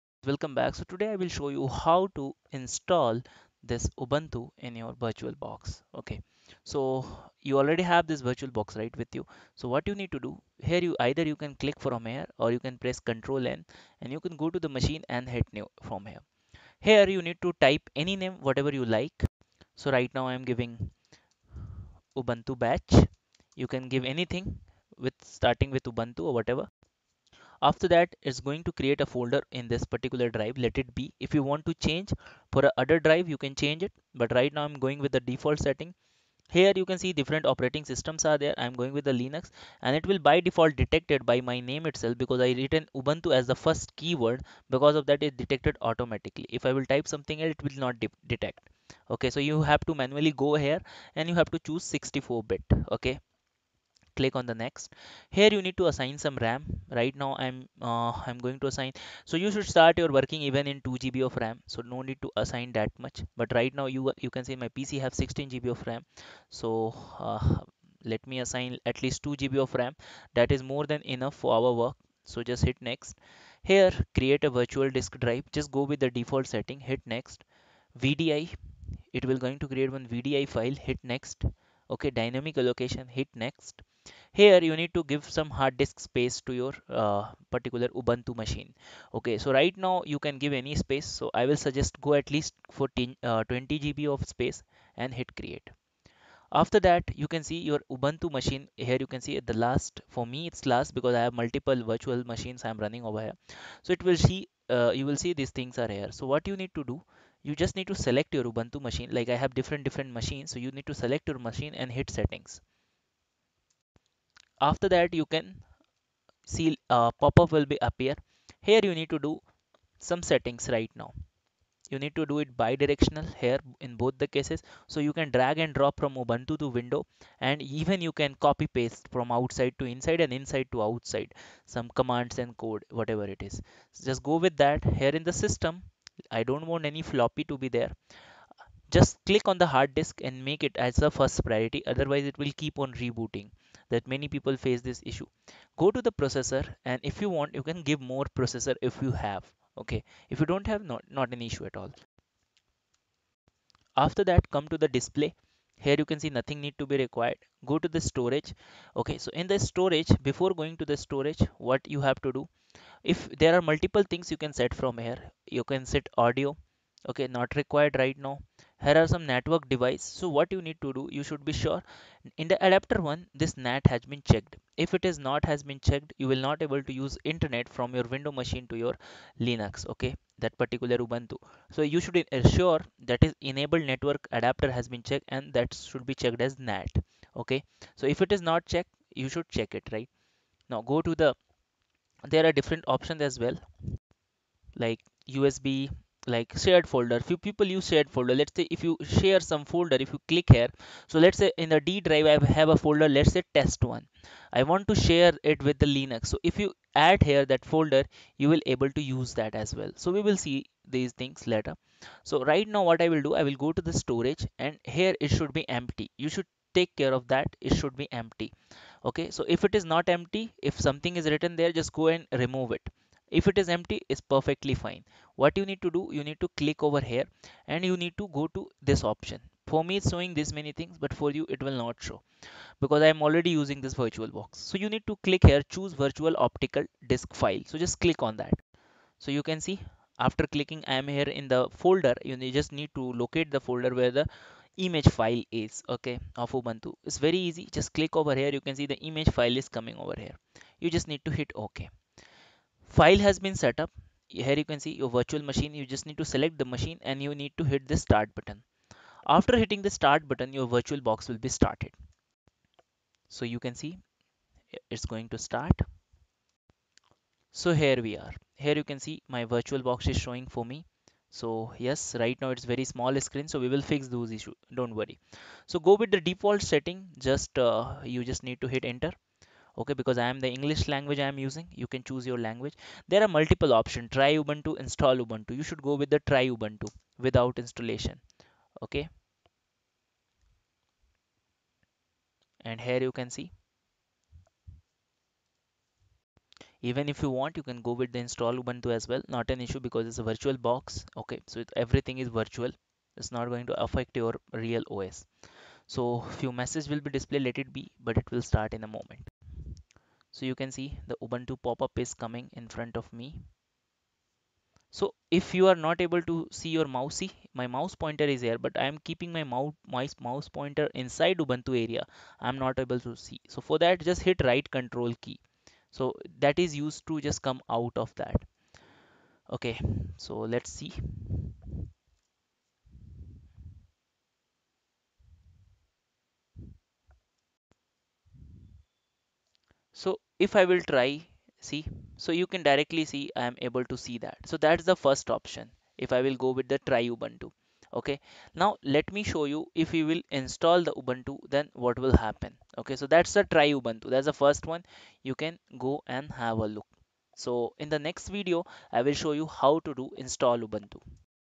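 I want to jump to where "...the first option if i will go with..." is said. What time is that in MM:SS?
05:44.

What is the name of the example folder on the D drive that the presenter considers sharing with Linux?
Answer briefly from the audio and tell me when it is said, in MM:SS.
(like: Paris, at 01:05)
test one, at 03:23.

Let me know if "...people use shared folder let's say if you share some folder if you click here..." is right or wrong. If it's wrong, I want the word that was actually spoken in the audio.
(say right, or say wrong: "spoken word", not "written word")
right.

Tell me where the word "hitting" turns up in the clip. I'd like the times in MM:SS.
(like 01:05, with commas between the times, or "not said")
04:19.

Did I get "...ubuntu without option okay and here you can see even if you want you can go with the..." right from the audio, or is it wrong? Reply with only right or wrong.
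wrong.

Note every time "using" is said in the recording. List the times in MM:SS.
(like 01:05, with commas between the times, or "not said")
03:53, 04:41.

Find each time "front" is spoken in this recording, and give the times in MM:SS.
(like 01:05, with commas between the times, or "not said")
05:12.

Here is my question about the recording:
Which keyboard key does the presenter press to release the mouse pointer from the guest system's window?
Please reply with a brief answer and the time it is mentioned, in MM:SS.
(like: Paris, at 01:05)
right control, at 05:24.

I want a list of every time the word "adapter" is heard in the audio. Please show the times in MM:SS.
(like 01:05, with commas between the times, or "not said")
02:52, 03:04.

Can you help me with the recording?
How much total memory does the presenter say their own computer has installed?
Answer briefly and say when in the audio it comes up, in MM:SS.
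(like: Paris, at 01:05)
16 GB, at 01:05.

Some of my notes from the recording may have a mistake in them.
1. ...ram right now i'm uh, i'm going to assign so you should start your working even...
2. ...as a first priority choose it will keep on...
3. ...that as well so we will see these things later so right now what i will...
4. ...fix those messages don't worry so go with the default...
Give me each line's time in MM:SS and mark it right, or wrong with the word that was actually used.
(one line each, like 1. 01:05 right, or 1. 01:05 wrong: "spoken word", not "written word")
1. 00:56 right
2. 02:20 wrong: "otherwise", not "choose"
3. 03:29 right
4. 04:33 wrong: "issues", not "messages".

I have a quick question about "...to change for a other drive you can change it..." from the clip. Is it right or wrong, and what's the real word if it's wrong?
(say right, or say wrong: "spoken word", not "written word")
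right.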